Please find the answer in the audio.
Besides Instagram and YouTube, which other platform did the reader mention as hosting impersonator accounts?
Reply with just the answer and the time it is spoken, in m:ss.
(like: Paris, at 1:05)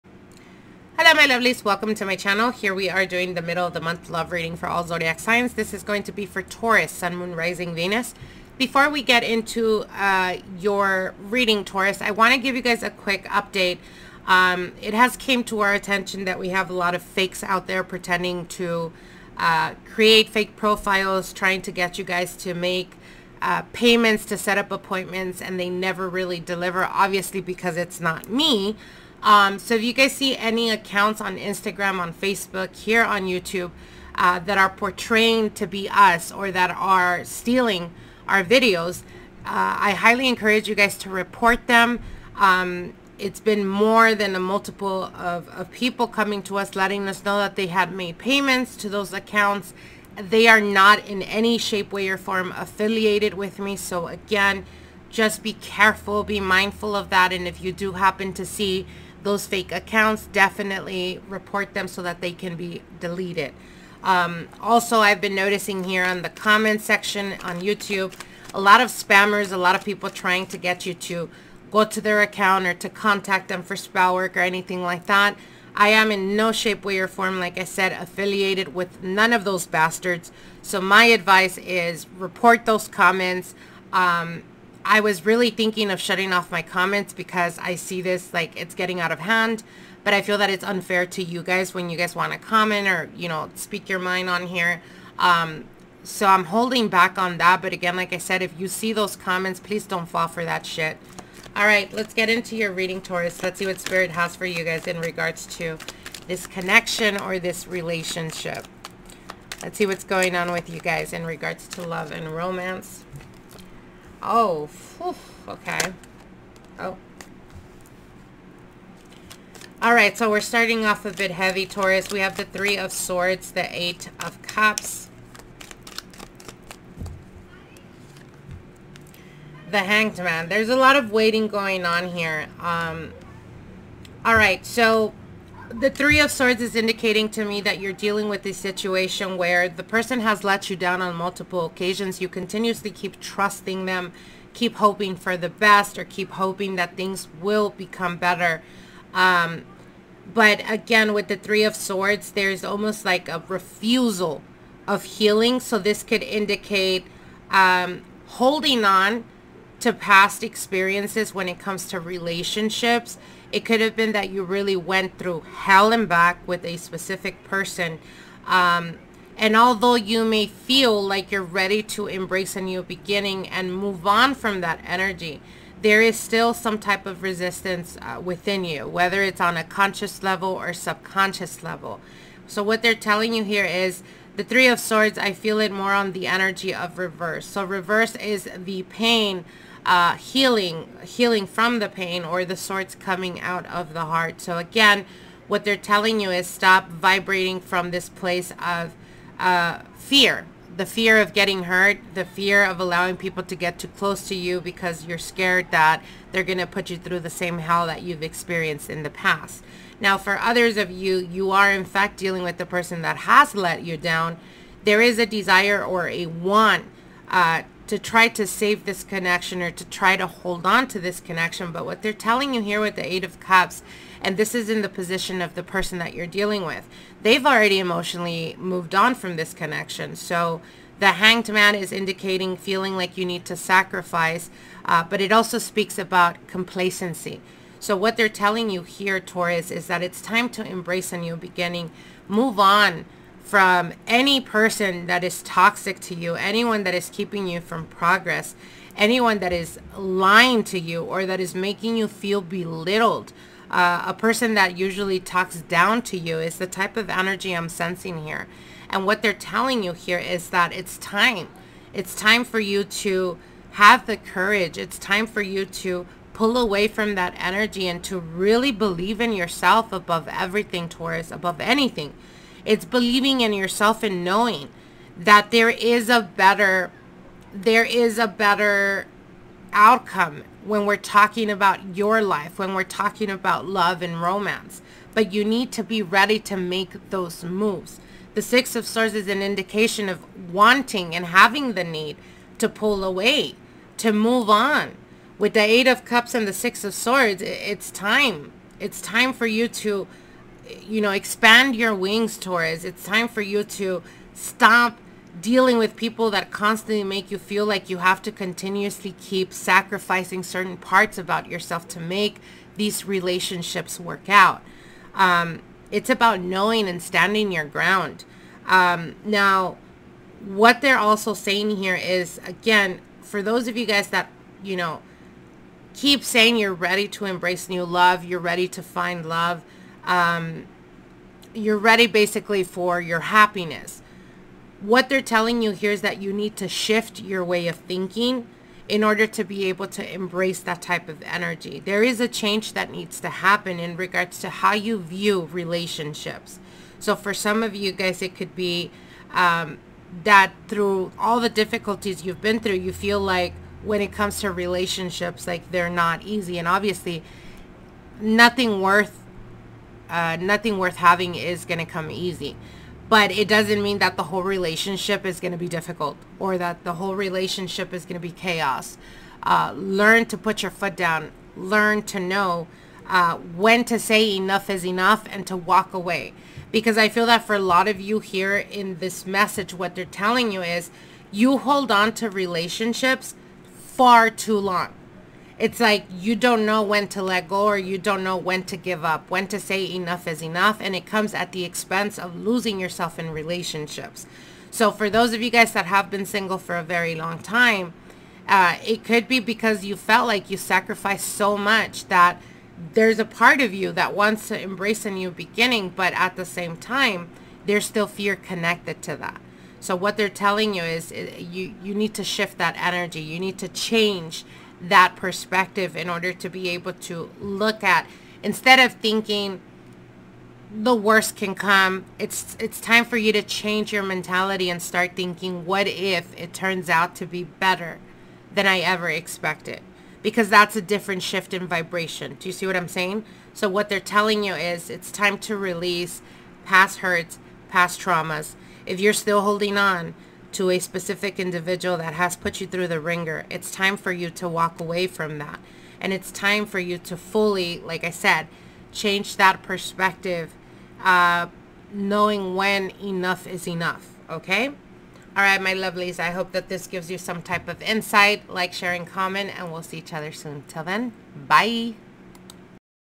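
Facebook, at 0:32.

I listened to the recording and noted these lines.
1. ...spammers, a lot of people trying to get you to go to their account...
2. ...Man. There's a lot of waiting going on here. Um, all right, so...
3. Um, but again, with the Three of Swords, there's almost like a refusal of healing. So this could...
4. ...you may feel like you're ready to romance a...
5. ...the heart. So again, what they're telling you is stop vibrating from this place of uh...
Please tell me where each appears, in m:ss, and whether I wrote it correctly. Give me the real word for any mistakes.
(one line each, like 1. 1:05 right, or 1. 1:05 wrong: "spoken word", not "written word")
1. 1:08 right
2. 2:10 right
3. 2:29 right
4. 2:49 wrong: "embrace", not "romance"
5. 3:13 right.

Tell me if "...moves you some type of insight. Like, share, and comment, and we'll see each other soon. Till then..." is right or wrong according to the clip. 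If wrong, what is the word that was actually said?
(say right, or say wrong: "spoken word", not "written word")
wrong: "gives", not "moves".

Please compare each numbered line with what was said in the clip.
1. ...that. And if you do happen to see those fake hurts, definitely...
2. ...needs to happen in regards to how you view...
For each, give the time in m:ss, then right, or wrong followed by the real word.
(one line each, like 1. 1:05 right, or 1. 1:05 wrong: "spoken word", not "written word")
1. 0:57 wrong: "accounts", not "hurts"
2. 5:42 right.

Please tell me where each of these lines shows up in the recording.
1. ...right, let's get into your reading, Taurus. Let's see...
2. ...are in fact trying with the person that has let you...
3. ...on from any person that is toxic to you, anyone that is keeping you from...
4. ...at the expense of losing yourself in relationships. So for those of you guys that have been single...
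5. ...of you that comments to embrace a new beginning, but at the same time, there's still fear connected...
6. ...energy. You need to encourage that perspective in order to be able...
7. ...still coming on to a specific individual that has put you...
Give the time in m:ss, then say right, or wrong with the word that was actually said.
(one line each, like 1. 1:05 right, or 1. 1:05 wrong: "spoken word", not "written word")
1. 1:41 right
2. 3:31 wrong: "dealing", not "trying"
3. 4:02 right
4. 6:31 right
5. 6:43 wrong: "wants", not "comments"
6. 6:52 wrong: "change", not "encourage"
7. 7:19 wrong: "holding", not "coming".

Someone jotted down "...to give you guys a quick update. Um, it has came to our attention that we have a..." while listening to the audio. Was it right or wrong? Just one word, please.
right.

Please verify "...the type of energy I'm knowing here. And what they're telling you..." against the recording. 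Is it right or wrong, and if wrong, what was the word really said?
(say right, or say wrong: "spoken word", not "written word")
wrong: "sensing", not "knowing".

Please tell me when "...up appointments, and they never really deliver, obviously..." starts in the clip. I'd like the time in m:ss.
0:24.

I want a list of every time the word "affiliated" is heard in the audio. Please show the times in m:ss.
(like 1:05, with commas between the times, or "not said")
0:52, 1:17.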